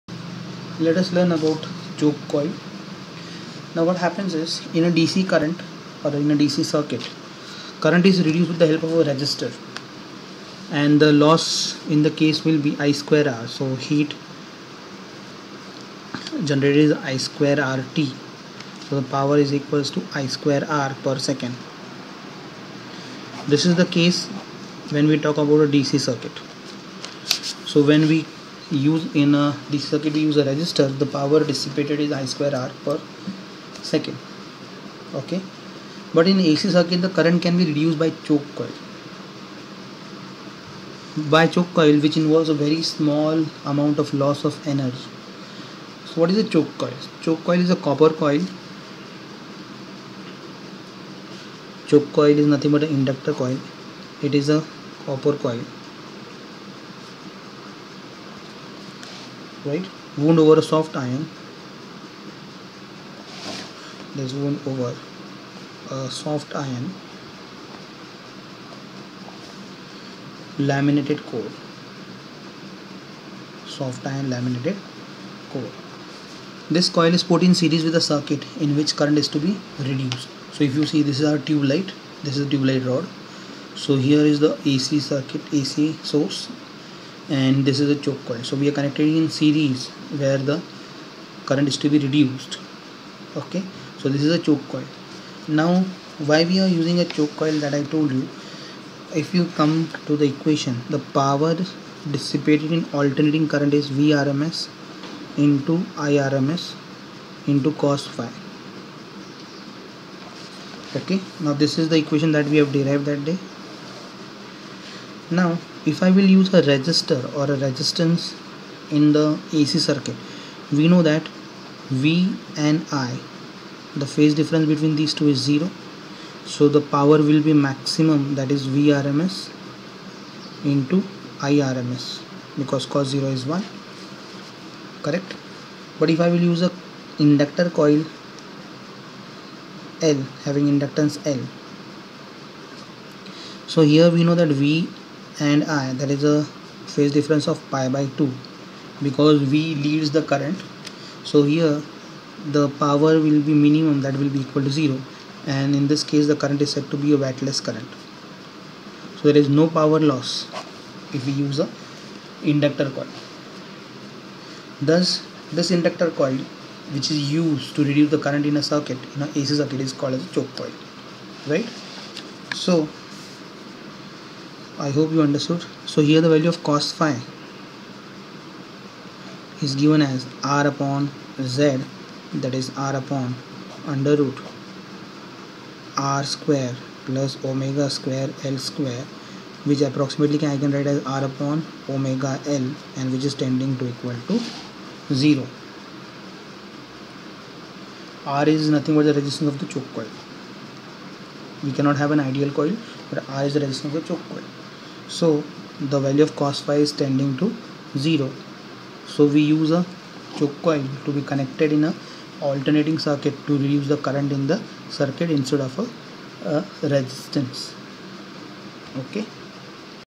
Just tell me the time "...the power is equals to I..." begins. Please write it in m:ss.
0:18.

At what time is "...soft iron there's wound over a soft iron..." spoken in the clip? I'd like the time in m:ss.
1:00.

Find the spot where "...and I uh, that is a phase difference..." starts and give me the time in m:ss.
2:25.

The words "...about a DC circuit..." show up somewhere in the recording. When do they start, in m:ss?
0:25.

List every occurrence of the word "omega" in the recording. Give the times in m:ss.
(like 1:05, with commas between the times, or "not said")
3:07, 3:11.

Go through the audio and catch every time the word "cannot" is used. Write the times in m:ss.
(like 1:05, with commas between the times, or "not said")
3:21.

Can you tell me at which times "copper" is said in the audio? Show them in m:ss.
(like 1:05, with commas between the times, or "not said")
0:47, 0:55.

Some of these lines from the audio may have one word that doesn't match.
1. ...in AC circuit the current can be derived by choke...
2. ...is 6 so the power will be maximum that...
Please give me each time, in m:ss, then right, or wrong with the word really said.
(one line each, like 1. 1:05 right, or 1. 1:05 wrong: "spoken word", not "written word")
1. 0:36 wrong: "reduced", not "derived"
2. 2:05 wrong: "0", not "6".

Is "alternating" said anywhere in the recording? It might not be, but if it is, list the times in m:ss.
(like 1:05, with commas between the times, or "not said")
1:42, 3:32.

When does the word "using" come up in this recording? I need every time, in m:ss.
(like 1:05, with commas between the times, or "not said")
1:36.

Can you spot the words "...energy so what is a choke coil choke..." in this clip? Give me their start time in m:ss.
0:44.